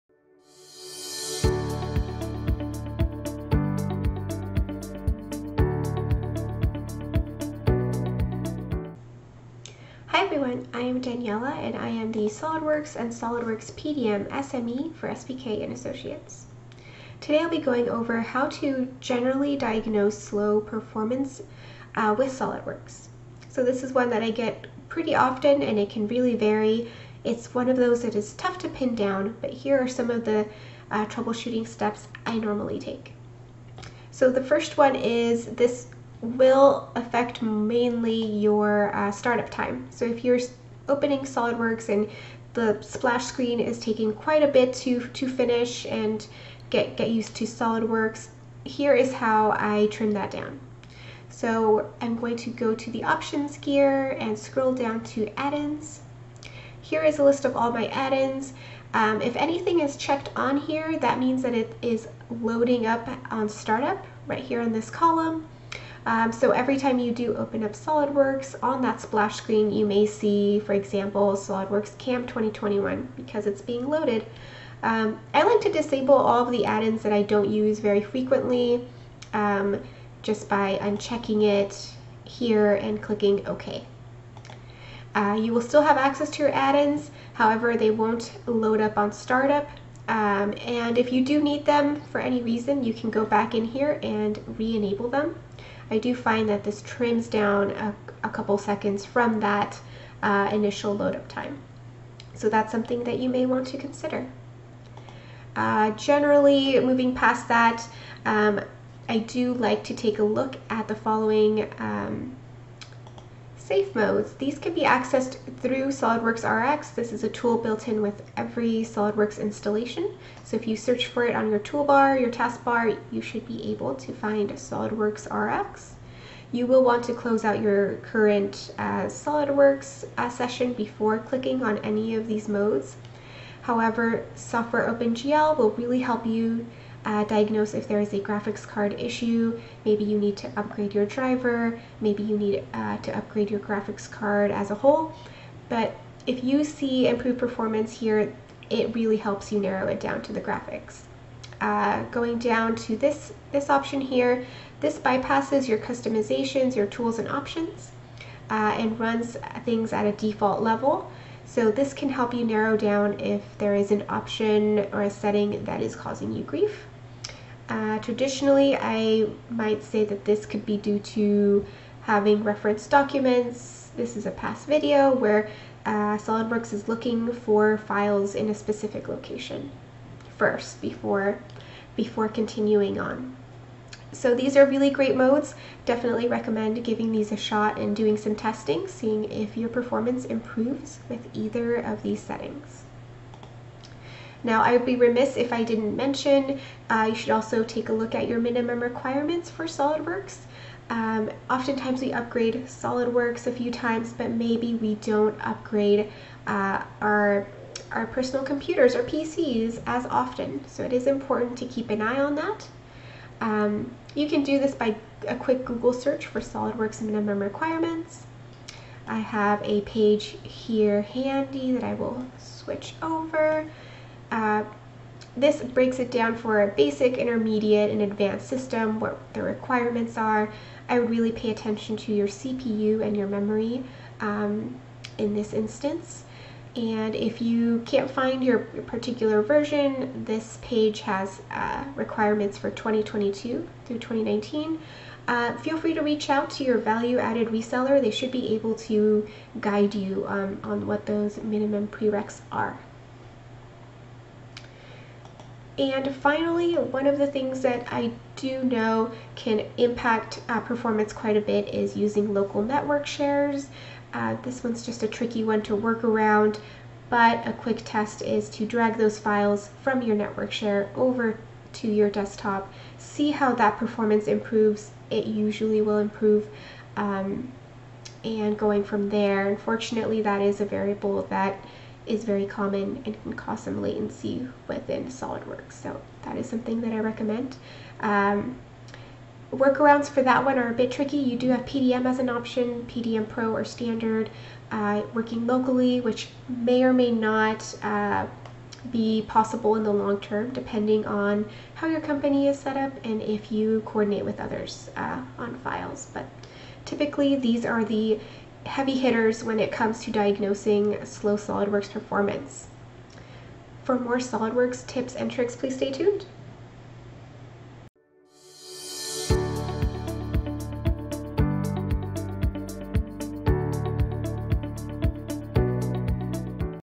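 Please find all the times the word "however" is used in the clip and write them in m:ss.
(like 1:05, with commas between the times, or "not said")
1:27, 2:13.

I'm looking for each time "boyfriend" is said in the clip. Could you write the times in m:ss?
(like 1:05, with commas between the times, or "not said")
not said.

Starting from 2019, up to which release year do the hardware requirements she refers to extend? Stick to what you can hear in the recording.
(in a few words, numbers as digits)
2022.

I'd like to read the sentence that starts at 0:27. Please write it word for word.
It's one of those that is tough to pin down, but here are some of the uh, troubleshooting steps I normally take.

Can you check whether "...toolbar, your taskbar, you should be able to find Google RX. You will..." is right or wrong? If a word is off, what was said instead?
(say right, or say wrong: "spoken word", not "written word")
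wrong: "SOLIDWORKS", not "Google".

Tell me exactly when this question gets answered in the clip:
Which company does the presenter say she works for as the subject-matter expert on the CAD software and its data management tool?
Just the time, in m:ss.
0:15.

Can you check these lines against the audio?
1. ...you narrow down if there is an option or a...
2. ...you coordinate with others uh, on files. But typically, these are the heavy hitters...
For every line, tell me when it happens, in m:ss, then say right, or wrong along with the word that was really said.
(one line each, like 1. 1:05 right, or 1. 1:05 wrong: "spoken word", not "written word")
1. 2:42 right
2. 5:03 right.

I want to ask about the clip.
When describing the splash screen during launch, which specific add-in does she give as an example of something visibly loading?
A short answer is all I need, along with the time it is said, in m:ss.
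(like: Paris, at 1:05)
SOLIDWORKS CAM 2021, at 1:11.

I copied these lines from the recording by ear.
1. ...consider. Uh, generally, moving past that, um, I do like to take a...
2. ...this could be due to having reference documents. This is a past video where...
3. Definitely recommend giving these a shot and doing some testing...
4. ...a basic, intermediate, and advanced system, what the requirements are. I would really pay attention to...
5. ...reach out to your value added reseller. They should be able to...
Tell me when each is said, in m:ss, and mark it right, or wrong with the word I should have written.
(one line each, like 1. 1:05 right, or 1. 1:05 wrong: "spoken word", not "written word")
1. 1:43 right
2. 2:50 right
3. 3:05 right
4. 3:46 right
5. 4:06 right.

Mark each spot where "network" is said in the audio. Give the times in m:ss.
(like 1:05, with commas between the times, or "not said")
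4:22, 4:30.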